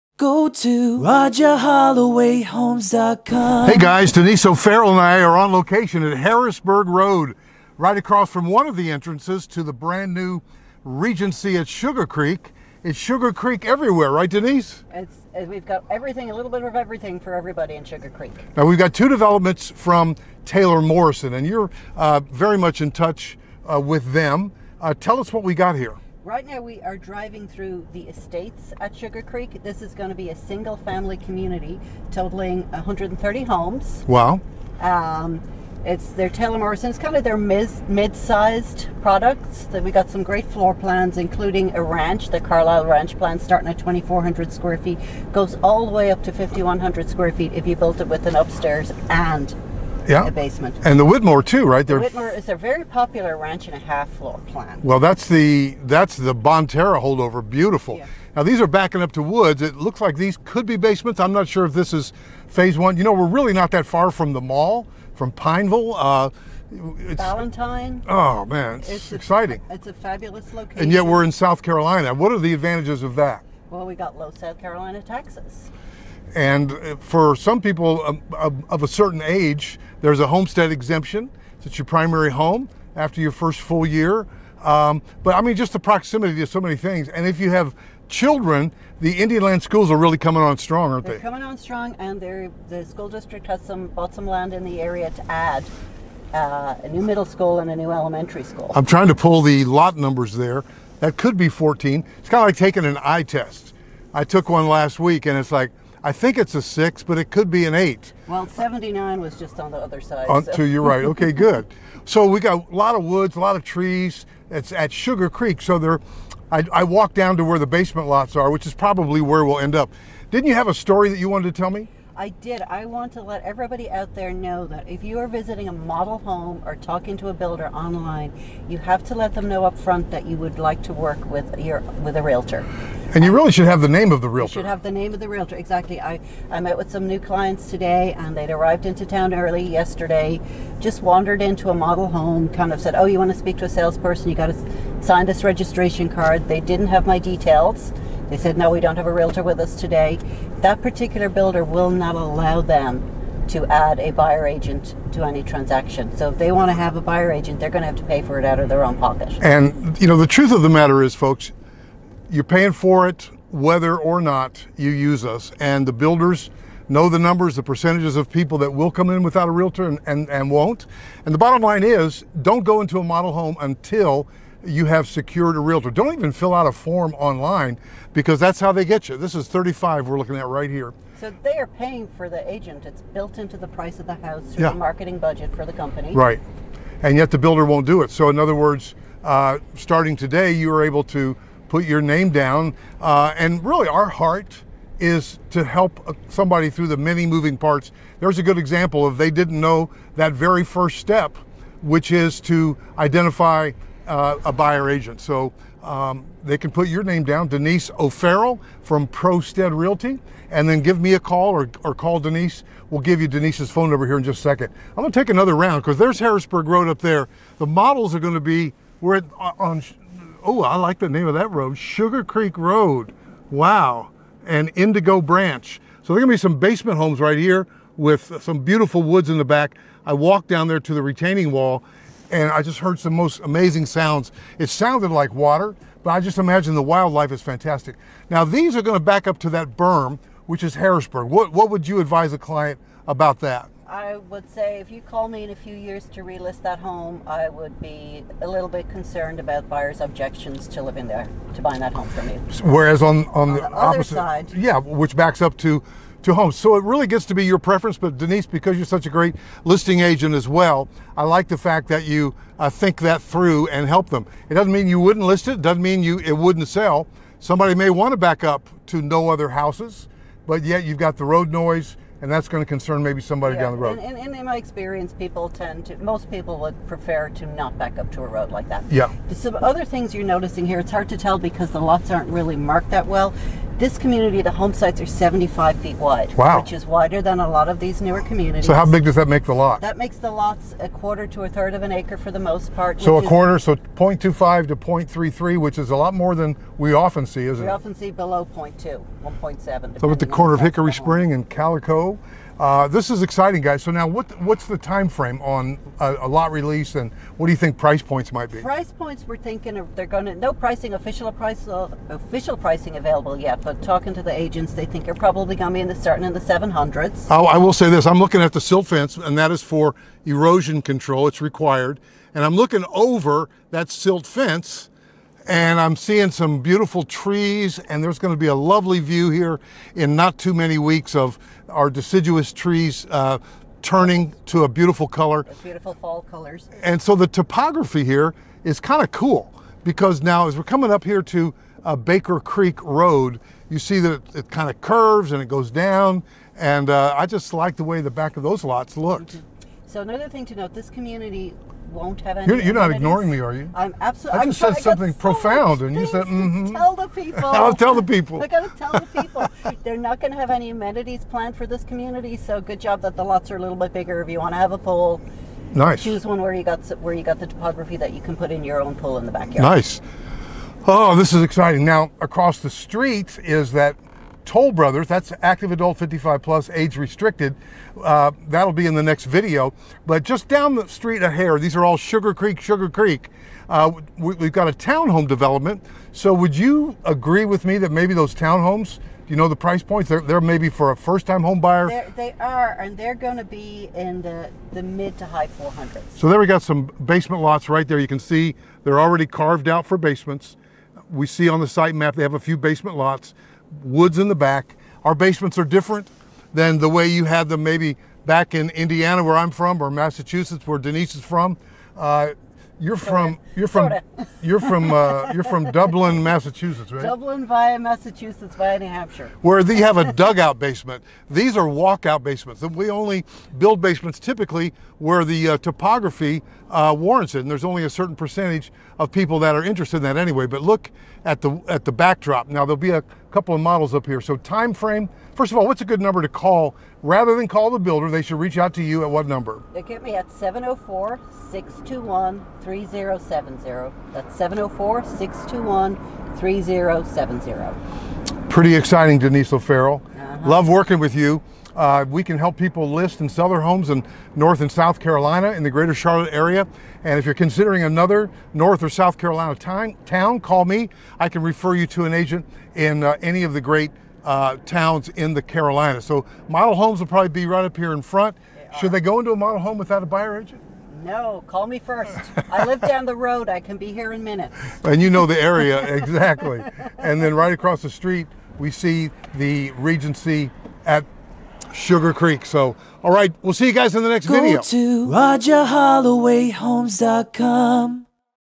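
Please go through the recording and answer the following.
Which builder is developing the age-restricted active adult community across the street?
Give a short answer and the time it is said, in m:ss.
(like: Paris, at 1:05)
Toll Brothers, at 6:14.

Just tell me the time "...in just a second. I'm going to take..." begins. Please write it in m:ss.
3:34.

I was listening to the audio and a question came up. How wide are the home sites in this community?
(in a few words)
75 feet.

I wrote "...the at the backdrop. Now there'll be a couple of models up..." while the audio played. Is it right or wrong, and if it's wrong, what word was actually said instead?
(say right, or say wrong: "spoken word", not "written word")
right.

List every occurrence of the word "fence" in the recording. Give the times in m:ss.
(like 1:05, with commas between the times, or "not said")
5:18, 5:24.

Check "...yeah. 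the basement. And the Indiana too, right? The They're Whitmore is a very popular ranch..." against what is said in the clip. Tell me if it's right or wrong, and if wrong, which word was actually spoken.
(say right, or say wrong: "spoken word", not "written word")
wrong: "Whitmore", not "Indiana".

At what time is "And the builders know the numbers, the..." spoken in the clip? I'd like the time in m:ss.
2:45.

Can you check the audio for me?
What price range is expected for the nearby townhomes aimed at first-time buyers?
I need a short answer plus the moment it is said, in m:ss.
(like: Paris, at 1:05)
mid to high 400s, at 6:34.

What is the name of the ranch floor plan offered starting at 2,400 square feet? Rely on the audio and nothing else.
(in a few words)
Carlyle Ranch.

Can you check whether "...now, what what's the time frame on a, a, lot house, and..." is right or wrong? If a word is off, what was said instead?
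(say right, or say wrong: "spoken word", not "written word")
wrong: "release", not "house".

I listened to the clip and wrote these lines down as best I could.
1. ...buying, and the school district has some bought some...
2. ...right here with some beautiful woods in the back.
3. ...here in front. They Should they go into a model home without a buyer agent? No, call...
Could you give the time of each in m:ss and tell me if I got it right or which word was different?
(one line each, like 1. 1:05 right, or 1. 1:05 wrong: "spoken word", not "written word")
1. 1:31 wrong: "strong", not "buying"
2. 3:47 right
3. 7:47 right.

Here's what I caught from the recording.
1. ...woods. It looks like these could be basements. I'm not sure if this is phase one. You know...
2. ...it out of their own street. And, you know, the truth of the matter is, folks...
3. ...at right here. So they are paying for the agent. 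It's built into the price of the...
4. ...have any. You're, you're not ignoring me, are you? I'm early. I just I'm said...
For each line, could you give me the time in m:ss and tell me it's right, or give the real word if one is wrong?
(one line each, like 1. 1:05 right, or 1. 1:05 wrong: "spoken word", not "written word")
1. 0:59 right
2. 2:38 wrong: "pocket", not "street"
3. 3:00 right
4. 5:52 wrong: "absolutely", not "early".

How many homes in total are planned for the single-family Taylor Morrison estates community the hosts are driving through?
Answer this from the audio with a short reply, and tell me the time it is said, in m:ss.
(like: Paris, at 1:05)
130, at 0:32.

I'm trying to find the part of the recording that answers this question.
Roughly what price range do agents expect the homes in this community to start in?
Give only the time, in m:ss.
5:16.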